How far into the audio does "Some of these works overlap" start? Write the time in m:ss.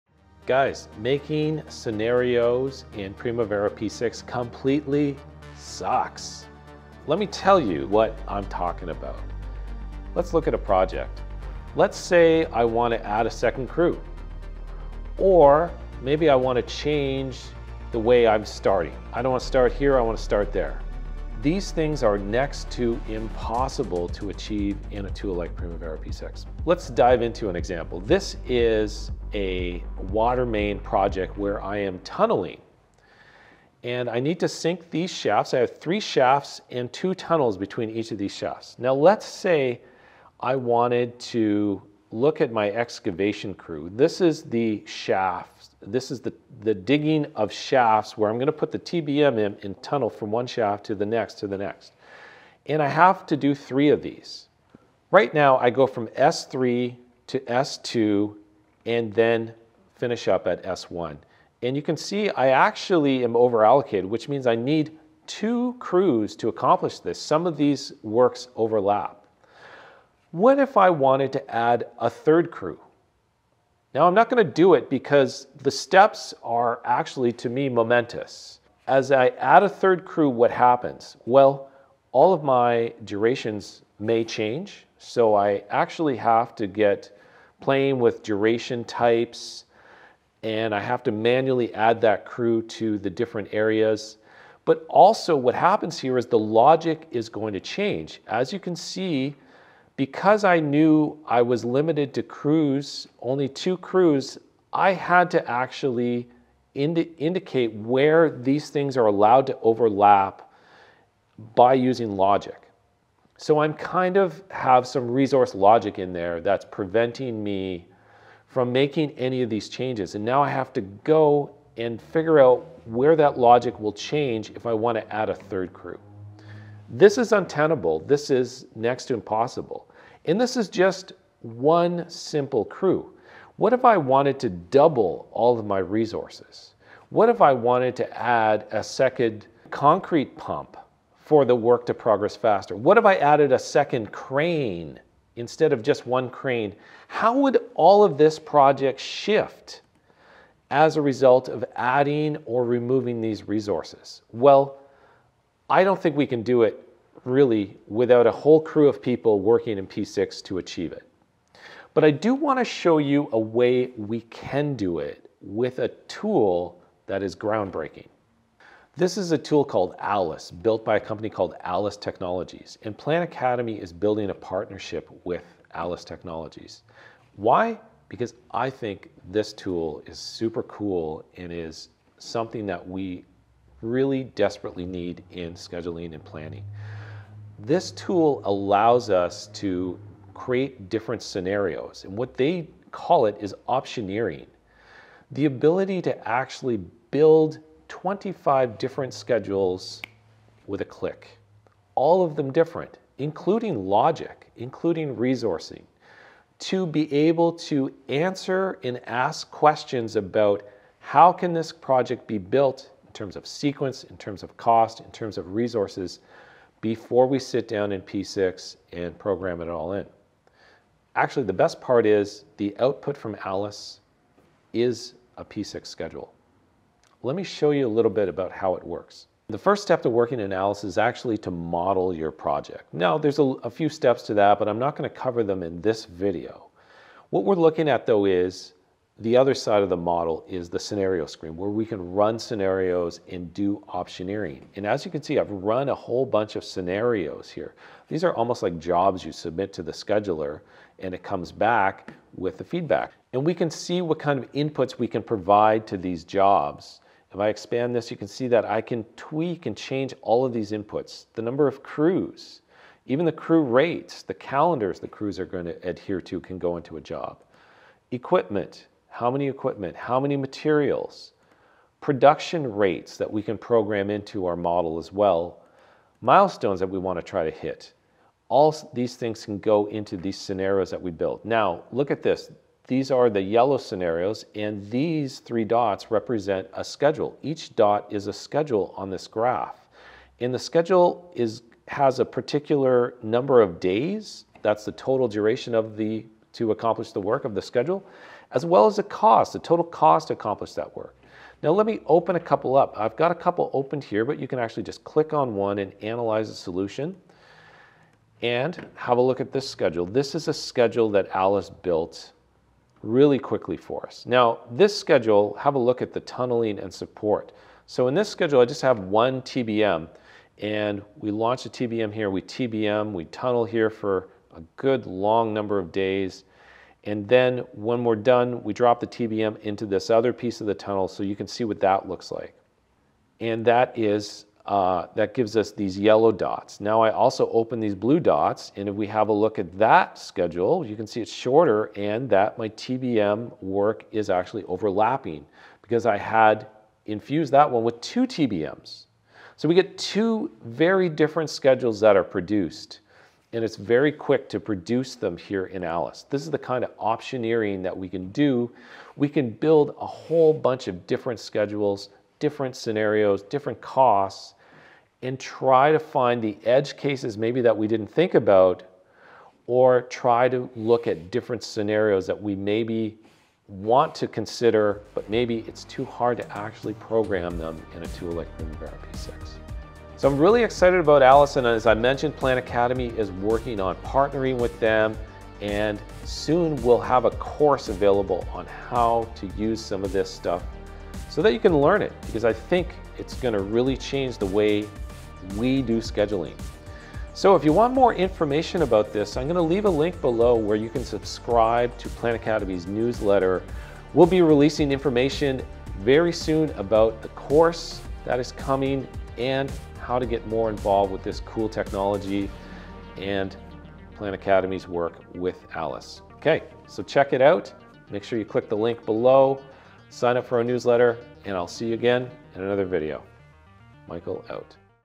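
1:07.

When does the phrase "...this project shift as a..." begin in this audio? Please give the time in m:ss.
2:28.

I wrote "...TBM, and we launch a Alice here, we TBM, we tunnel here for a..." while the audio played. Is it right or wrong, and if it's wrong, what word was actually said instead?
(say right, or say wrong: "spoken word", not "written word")
wrong: "TBM", not "Alice".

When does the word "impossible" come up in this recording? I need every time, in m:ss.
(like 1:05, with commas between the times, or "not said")
0:23, 2:09.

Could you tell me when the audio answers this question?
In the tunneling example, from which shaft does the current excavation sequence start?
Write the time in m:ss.
0:56.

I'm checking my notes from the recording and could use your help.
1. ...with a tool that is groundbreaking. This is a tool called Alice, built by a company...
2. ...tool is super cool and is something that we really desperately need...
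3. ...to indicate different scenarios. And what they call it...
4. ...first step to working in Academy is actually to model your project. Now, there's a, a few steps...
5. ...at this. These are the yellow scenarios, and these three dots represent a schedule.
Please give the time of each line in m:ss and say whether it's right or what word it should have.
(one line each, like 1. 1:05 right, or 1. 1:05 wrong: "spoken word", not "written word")
1. 2:45 right
2. 2:59 right
3. 3:09 wrong: "create", not "indicate"
4. 3:49 wrong: "Alice", not "Academy"
5. 4:42 right.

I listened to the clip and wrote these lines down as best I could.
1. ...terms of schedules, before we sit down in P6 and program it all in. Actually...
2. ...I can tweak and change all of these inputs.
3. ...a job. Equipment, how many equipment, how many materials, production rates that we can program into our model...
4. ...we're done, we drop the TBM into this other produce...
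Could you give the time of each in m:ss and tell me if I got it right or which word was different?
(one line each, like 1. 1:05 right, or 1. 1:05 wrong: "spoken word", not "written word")
1. 3:35 wrong: "resources", not "schedules"
2. 4:18 right
3. 4:26 right
4. 5:28 wrong: "piece", not "produce".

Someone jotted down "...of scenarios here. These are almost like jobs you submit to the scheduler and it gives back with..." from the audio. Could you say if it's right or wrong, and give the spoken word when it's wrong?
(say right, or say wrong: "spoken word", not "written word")
wrong: "comes", not "gives".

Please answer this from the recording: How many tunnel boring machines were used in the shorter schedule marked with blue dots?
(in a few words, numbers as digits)
2.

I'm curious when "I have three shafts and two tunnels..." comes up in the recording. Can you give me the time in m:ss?
0:35.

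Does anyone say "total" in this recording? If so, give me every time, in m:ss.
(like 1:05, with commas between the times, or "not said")
4:54, 4:59.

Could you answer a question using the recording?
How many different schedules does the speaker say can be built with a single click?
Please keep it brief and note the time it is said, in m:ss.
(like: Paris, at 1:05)
25, at 3:17.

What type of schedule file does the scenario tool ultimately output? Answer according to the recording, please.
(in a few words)
P6 schedule.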